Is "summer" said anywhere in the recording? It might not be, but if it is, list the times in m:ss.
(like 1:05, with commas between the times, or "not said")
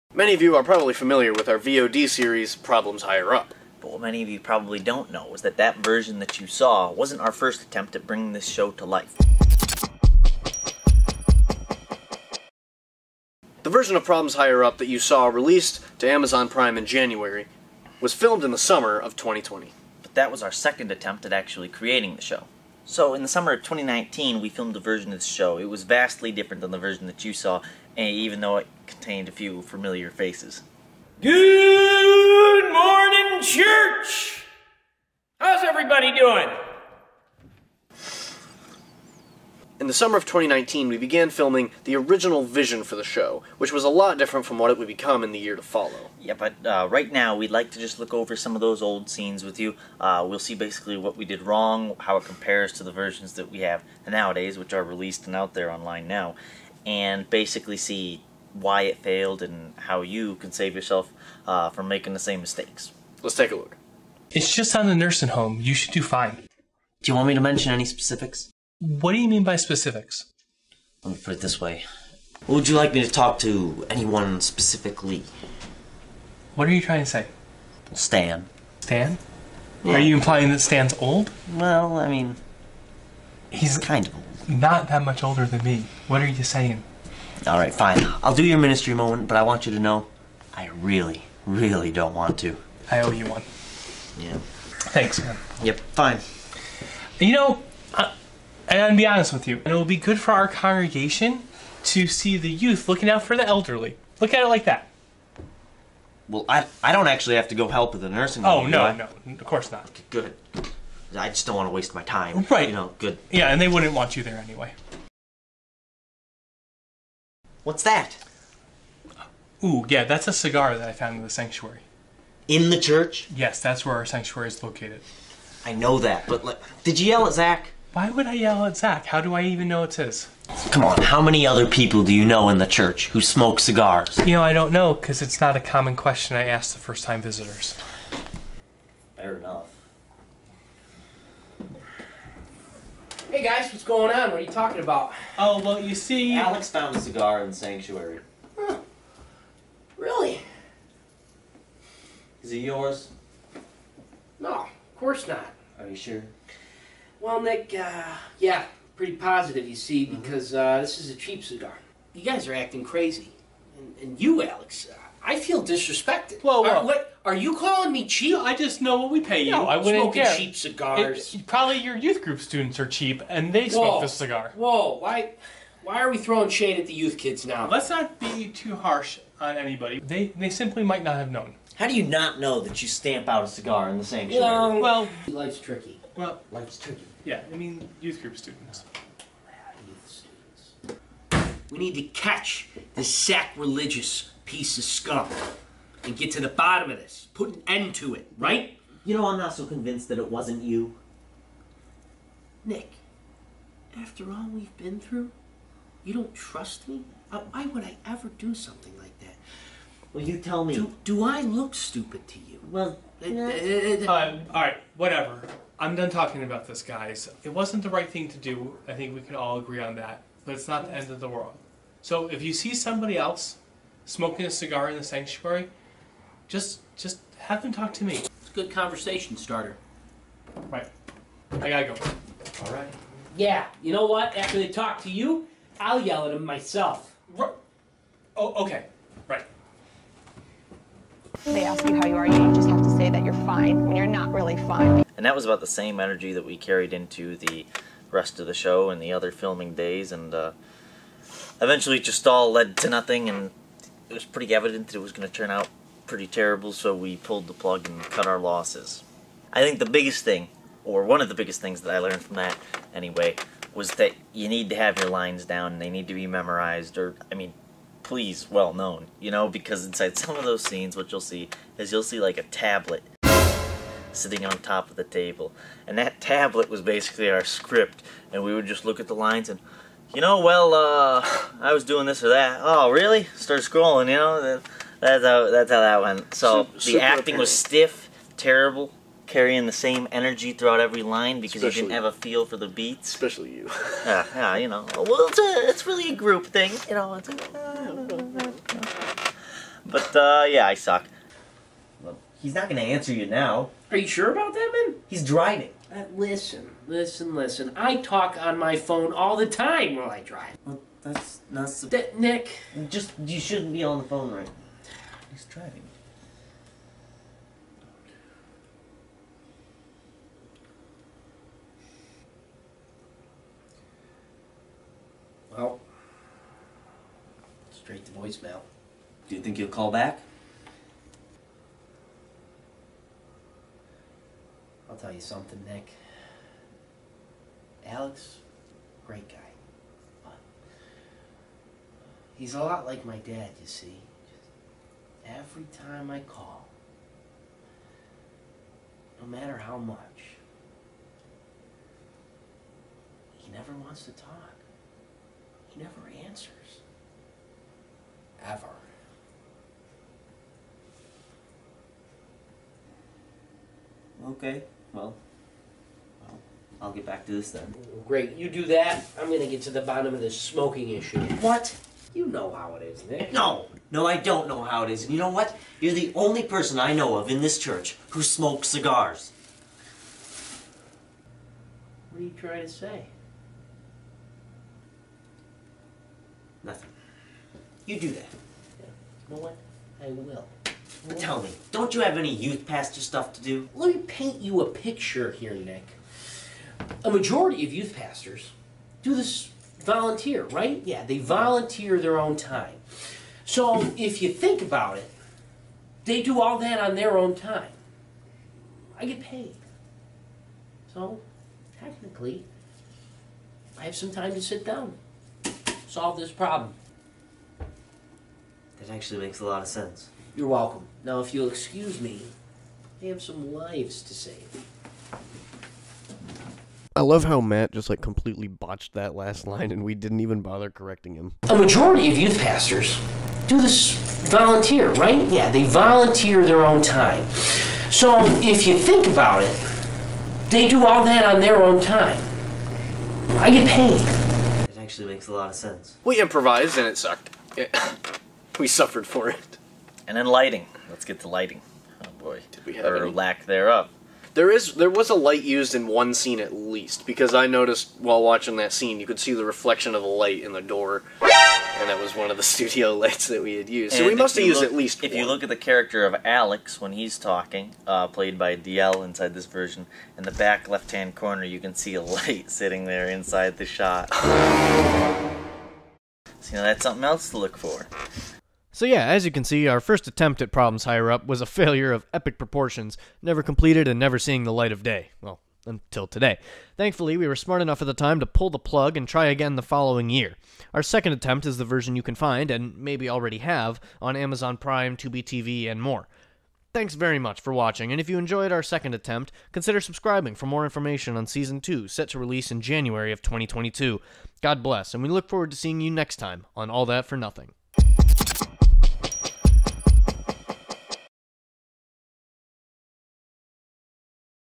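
0:18, 0:23, 0:39.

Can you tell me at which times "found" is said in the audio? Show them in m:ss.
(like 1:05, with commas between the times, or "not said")
2:00, 2:26.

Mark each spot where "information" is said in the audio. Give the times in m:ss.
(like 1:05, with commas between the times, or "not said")
8:20.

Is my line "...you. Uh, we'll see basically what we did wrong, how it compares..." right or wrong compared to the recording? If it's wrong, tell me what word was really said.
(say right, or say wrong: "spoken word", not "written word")
right.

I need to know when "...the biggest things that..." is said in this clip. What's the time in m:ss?
4:21.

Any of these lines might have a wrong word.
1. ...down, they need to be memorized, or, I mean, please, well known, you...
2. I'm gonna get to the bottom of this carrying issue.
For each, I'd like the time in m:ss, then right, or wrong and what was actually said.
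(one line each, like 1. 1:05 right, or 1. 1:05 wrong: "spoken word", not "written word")
1. 4:25 right
2. 6:09 wrong: "smoking", not "carrying".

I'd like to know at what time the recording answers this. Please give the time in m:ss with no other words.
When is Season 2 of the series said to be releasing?
8:22.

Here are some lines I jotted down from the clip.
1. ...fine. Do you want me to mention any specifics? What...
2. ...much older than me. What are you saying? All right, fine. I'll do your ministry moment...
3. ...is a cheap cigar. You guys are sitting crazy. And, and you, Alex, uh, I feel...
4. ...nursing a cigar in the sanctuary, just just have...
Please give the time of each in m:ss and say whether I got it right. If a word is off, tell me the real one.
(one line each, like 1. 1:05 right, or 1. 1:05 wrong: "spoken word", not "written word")
1. 1:06 right
2. 1:25 right
3. 2:40 wrong: "acting", not "sitting"
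4. 3:44 wrong: "smoking", not "nursing".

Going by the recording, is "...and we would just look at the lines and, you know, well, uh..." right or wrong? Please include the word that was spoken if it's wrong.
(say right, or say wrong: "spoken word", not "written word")
right.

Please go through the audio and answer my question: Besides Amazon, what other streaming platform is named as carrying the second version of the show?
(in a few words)
Tubi TV.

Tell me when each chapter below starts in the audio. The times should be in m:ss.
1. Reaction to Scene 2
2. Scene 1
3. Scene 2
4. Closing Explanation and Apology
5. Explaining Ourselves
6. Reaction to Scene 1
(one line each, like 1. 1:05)
1. 7:06
2. 1:04
3. 5:01
4. 7:58
5. 0:13
6. 4:01.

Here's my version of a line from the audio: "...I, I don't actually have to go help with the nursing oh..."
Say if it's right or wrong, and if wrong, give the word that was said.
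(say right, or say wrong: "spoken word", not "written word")
right.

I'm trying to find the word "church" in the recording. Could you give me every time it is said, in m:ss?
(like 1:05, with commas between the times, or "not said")
0:33, 2:02, 2:12, 6:17.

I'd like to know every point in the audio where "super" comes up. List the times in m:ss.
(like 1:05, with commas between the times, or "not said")
4:46.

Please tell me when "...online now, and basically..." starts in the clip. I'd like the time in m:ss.
0:55.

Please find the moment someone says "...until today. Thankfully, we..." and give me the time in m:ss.
8:05.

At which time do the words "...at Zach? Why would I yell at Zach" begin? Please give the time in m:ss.
2:07.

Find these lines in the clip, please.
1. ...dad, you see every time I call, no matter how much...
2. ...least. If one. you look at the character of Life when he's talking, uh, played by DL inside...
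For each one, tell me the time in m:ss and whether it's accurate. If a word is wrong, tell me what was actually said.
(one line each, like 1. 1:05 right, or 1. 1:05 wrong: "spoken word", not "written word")
1. 5:43 right
2. 7:44 wrong: "Alex", not "Life".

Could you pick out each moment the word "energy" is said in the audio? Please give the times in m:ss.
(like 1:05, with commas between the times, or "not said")
4:06, 4:50.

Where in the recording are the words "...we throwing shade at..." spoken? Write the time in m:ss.
2:56.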